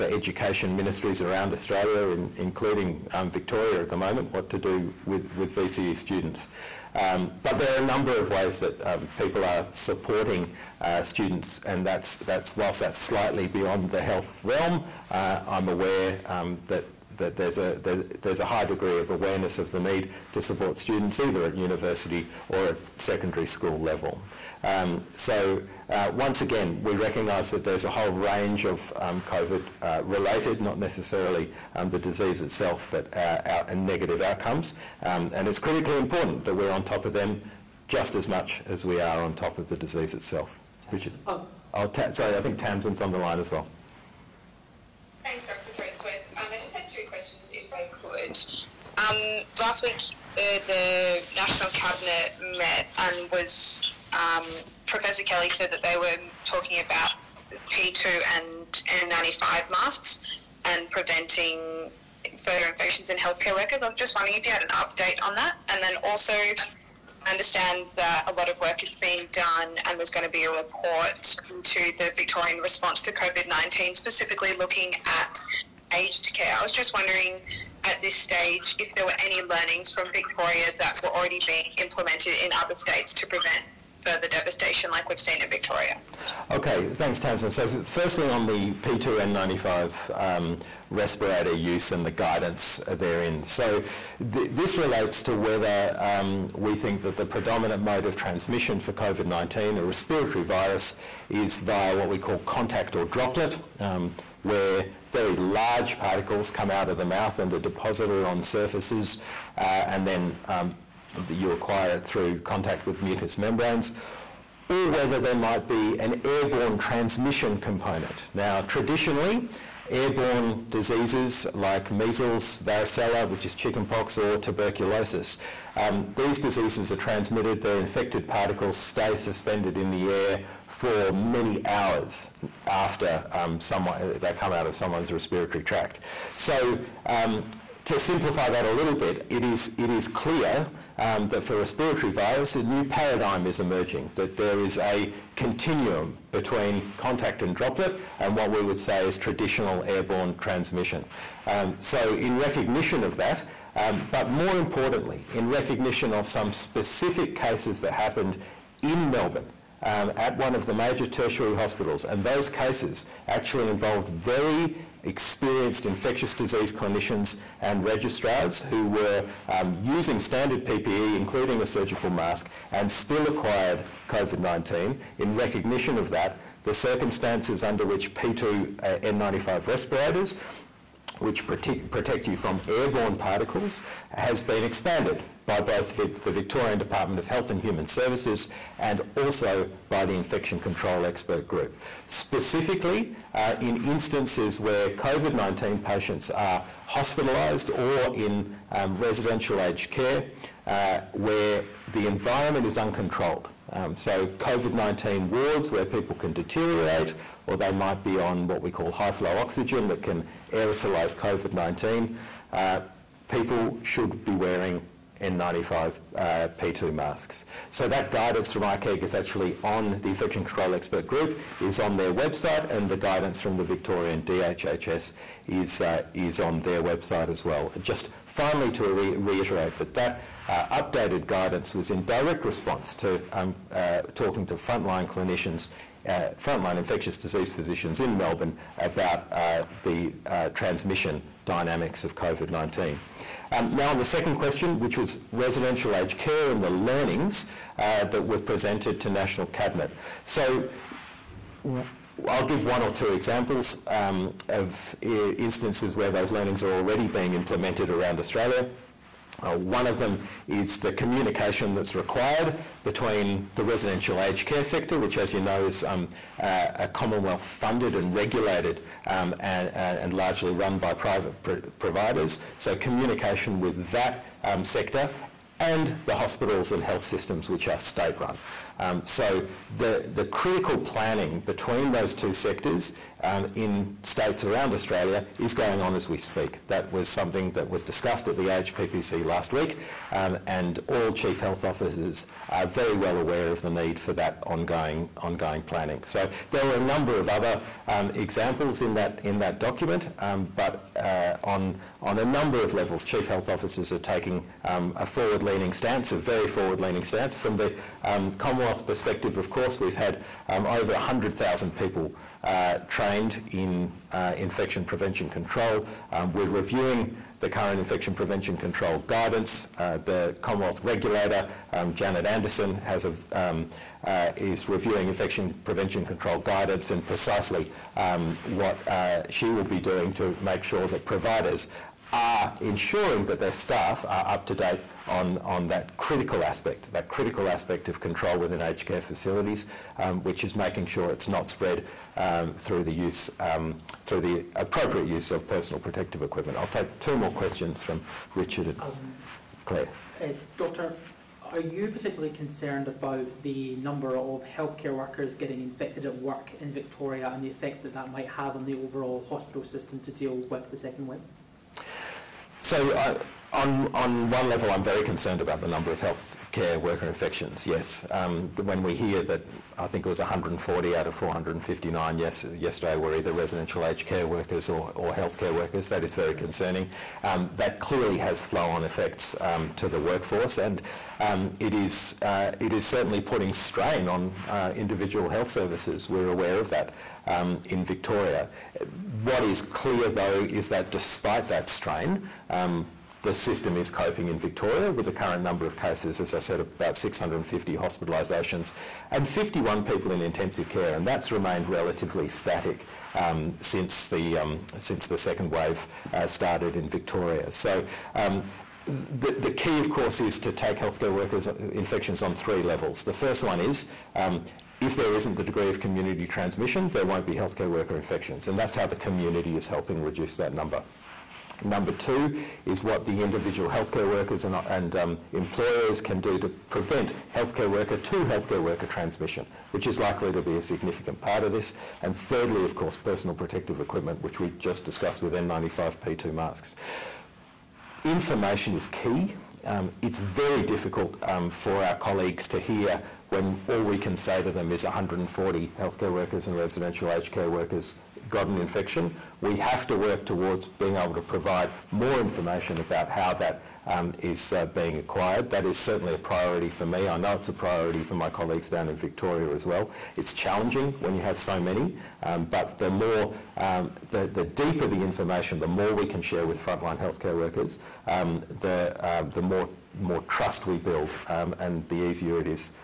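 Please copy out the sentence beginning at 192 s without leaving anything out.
Specifically, uh, in instances where COVID 19 patients are hospitalised or in um, residential aged care, uh, where the environment is uncontrolled.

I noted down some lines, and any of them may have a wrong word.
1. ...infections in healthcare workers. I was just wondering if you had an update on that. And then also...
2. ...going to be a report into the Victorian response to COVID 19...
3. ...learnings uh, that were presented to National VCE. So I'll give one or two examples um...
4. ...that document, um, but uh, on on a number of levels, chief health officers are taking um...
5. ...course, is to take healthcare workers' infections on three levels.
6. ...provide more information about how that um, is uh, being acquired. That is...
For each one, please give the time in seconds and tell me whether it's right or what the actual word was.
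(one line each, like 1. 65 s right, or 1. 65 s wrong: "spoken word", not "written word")
1. 62 s right
2. 70 s right
3. 246 s wrong: "Cabinet", not "VCE"
4. 299 s right
5. 409 s right
6. 451 s right.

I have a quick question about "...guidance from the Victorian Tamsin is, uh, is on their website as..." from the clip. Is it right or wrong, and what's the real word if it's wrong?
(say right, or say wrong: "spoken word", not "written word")
wrong: "DHHS", not "Tamsin".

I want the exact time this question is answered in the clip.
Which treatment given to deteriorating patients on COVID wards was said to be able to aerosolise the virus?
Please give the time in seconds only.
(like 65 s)
208 s.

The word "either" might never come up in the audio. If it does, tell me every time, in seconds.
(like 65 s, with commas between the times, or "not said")
21 s, 373 s.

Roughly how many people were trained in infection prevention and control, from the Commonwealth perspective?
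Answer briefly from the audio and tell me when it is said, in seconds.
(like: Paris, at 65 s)
over 100,000, at 310 s.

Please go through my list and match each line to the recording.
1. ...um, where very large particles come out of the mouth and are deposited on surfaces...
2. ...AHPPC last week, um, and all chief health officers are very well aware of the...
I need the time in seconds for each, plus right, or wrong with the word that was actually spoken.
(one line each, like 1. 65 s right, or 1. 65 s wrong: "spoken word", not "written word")
1. 103 s right
2. 288 s right.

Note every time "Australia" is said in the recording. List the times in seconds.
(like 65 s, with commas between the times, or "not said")
1 s, 258 s, 284 s.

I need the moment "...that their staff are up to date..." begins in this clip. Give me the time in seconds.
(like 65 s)
333 s.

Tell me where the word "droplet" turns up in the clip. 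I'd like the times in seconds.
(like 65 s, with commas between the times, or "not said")
103 s, 147 s.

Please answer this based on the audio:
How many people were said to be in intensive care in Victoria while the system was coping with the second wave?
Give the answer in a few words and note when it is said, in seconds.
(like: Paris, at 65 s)
51, at 399 s.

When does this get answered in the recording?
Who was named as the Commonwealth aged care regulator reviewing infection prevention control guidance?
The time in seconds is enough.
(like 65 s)
321 s.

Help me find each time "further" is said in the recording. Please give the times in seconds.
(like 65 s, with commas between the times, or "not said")
62 s, 84 s.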